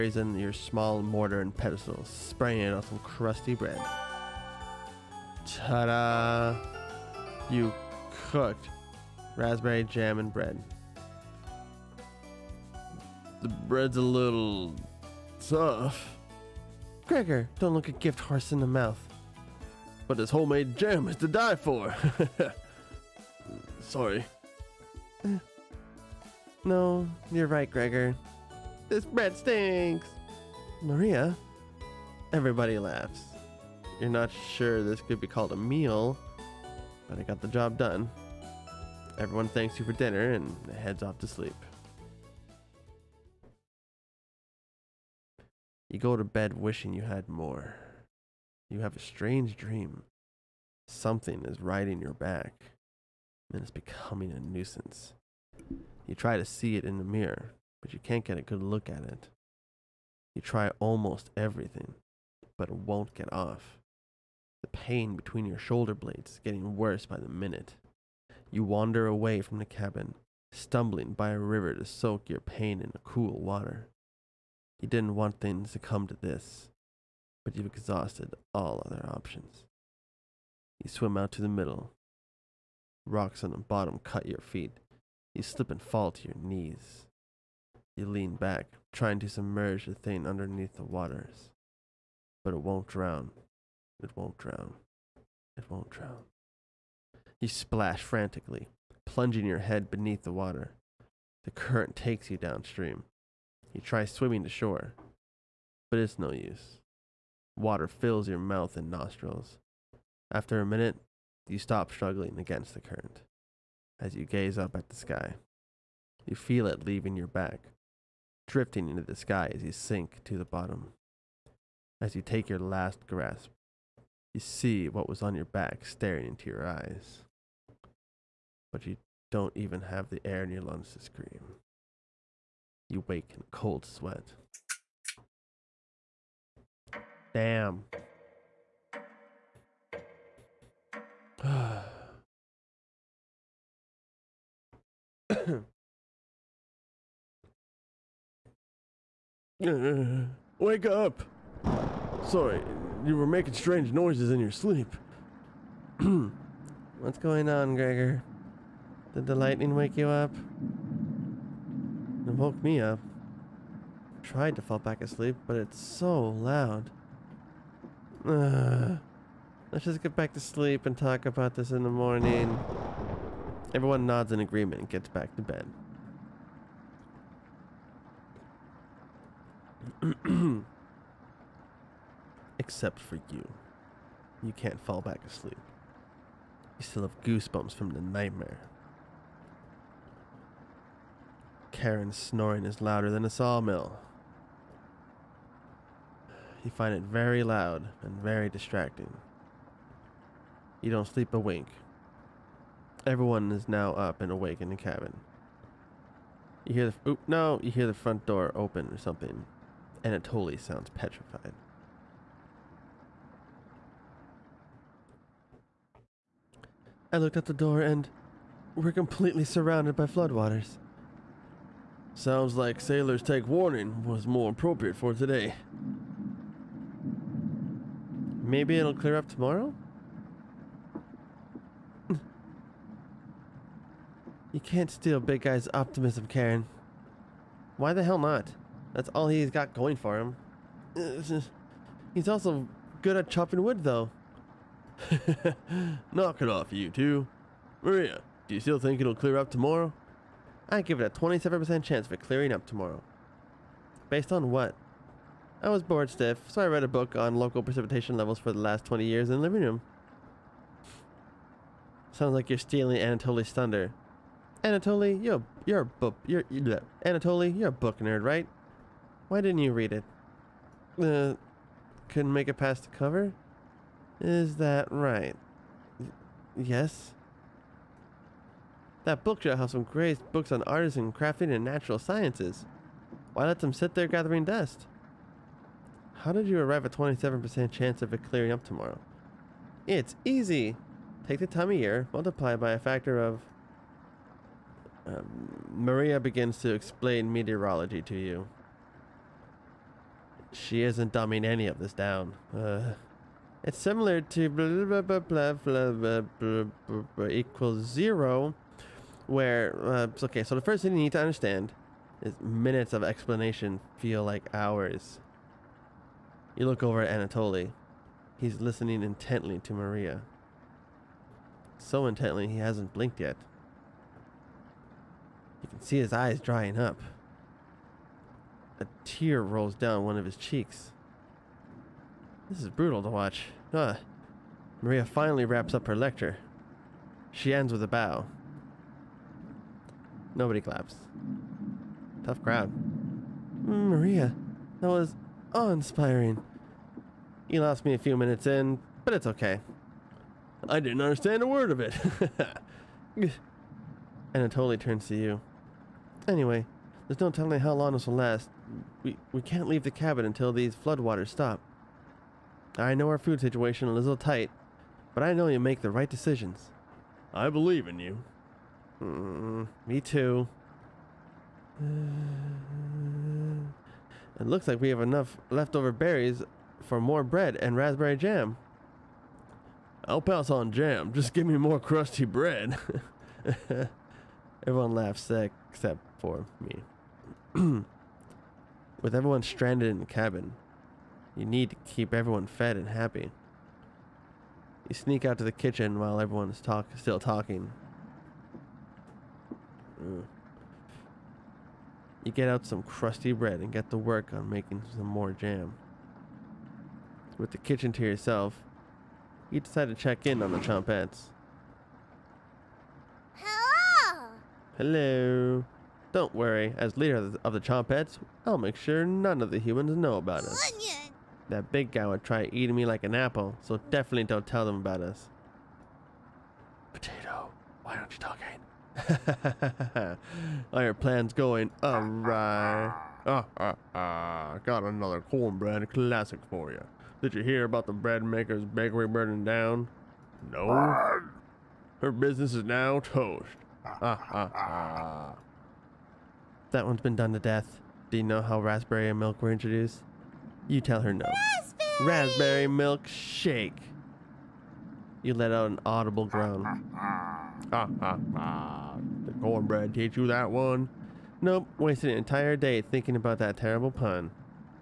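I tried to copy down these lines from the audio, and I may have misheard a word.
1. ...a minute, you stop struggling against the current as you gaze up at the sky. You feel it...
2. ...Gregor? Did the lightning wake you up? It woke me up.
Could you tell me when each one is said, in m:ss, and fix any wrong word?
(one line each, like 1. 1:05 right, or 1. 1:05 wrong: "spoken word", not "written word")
1. 1:50 right
2. 2:37 right.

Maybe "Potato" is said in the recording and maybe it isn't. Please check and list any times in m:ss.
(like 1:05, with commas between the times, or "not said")
7:06.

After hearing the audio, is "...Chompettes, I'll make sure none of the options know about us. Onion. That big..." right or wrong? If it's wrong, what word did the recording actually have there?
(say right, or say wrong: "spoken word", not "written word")
wrong: "humans", not "options".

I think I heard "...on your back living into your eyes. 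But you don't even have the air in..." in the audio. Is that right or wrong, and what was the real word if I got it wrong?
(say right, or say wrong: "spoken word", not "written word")
wrong: "staring", not "living".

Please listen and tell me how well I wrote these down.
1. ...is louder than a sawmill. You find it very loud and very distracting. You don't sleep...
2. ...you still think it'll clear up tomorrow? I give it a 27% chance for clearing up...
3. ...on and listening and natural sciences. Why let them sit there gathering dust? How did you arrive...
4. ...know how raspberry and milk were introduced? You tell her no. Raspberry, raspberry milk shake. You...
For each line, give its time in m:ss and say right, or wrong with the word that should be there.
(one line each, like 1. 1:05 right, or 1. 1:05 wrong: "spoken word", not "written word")
1. 3:12 right
2. 4:08 right
3. 4:40 wrong: "crafting", not "listening"
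4. 7:28 right.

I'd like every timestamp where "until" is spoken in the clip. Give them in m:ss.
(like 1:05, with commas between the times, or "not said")
6:00.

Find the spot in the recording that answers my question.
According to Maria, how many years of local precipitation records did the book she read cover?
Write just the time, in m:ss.
4:18.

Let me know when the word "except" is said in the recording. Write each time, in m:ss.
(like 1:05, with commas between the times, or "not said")
3:02, 6:25.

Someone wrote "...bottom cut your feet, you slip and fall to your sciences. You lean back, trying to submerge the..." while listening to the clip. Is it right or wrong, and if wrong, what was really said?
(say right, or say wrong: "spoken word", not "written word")
wrong: "knees", not "sciences".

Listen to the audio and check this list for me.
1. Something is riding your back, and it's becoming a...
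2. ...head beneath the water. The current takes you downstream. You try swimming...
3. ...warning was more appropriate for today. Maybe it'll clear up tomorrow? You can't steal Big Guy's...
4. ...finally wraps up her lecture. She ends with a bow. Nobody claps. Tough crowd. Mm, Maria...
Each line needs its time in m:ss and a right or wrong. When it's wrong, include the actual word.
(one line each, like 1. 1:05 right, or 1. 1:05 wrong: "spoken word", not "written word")
1. 0:50 right
2. 1:39 right
3. 3:43 right
4. 5:35 right.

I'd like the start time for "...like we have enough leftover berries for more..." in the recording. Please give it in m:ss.
6:14.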